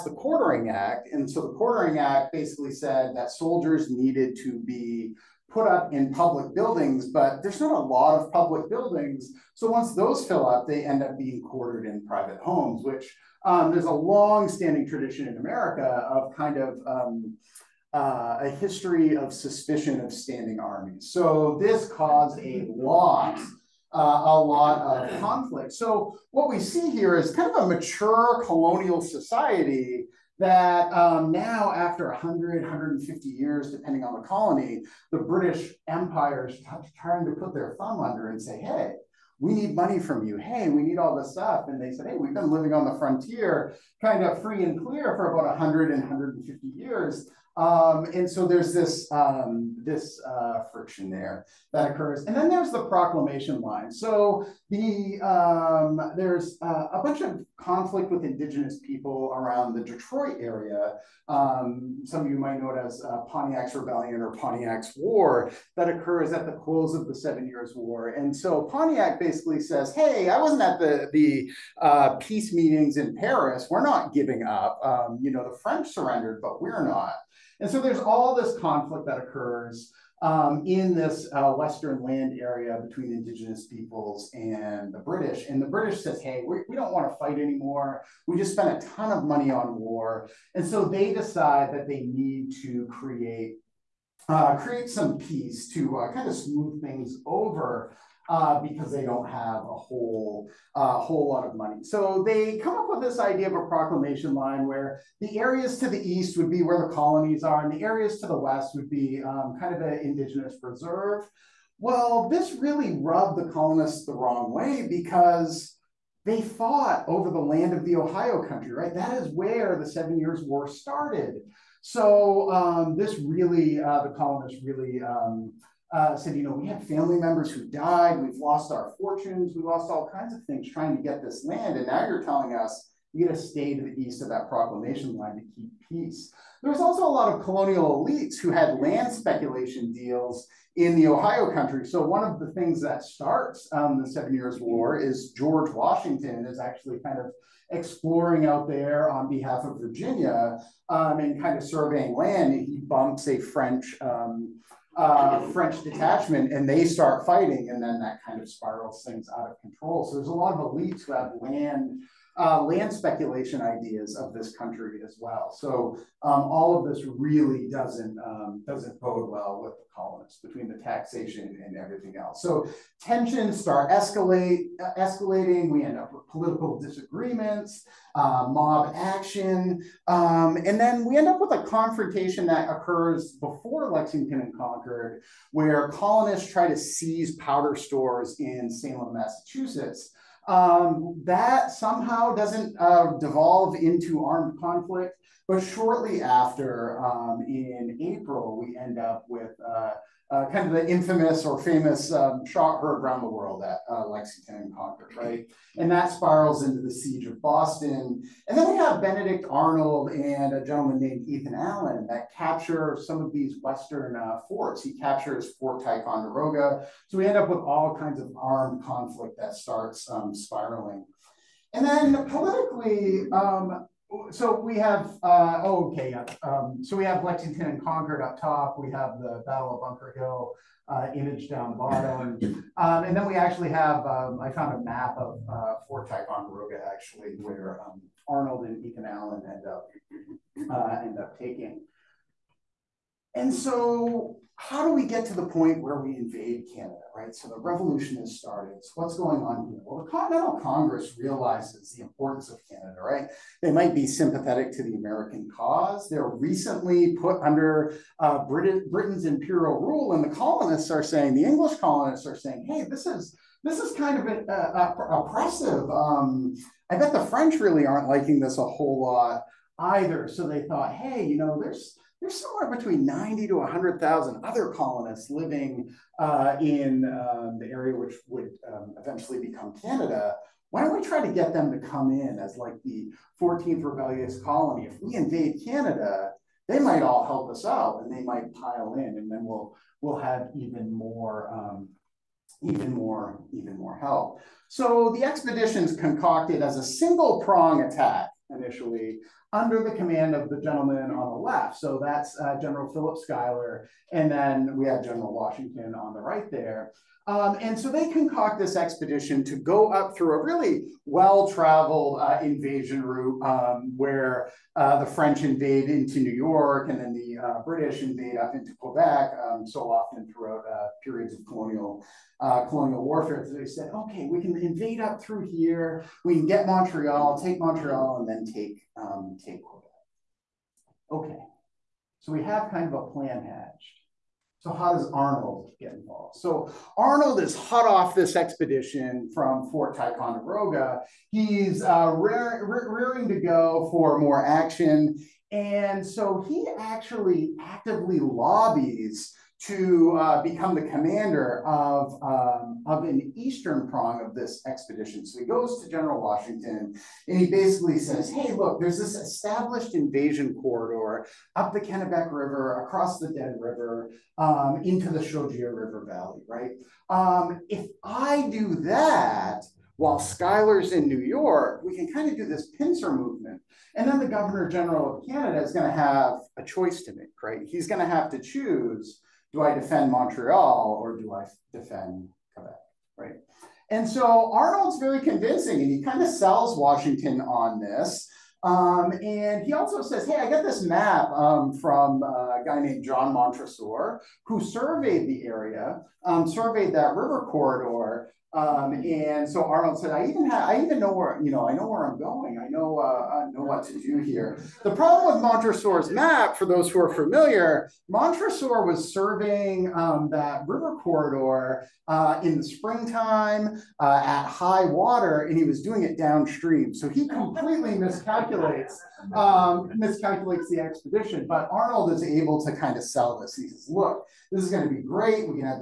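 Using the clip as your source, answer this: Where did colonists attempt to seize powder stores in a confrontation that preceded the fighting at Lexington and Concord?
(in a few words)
Salem, Massachusetts.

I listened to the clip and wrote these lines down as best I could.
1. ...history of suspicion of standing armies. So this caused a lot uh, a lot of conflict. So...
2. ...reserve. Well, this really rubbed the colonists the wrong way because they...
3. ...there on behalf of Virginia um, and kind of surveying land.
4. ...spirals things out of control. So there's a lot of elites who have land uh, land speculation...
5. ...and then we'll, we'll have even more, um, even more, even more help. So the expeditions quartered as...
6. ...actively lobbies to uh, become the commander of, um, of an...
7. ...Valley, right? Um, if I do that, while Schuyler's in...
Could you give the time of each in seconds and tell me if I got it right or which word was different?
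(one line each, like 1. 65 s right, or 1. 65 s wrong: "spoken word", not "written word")
1. 18 s right
2. 110 s right
3. 148 s right
4. 158 s right
5. 289 s wrong: "concocted", not "quartered"
6. 347 s right
7. 366 s right.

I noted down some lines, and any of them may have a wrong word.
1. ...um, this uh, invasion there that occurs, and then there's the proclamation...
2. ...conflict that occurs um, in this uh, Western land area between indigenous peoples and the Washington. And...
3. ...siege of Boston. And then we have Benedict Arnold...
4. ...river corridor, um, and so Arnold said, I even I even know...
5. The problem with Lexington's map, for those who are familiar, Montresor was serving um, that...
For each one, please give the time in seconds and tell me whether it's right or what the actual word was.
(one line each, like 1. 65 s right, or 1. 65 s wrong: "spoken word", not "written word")
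1. 49 s wrong: "friction", not "invasion"
2. 78 s wrong: "British", not "Washington"
3. 206 s right
4. 397 s right
5. 404 s wrong: "Montresor", not "Lexington".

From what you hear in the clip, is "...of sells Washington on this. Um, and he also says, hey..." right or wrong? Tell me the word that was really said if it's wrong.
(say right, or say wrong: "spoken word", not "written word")
right.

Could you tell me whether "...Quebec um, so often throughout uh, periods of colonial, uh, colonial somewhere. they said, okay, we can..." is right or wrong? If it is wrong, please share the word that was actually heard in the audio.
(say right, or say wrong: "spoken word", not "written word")
wrong: "warfare", not "somewhere".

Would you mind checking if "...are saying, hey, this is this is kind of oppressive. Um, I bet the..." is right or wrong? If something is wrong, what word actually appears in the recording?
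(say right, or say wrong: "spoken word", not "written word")
right.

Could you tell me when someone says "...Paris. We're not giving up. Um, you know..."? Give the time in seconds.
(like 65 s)
73 s.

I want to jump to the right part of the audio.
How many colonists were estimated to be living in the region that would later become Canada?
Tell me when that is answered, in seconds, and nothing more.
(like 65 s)
273 s.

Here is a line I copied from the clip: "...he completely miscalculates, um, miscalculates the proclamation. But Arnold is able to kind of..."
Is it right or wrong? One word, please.
wrong.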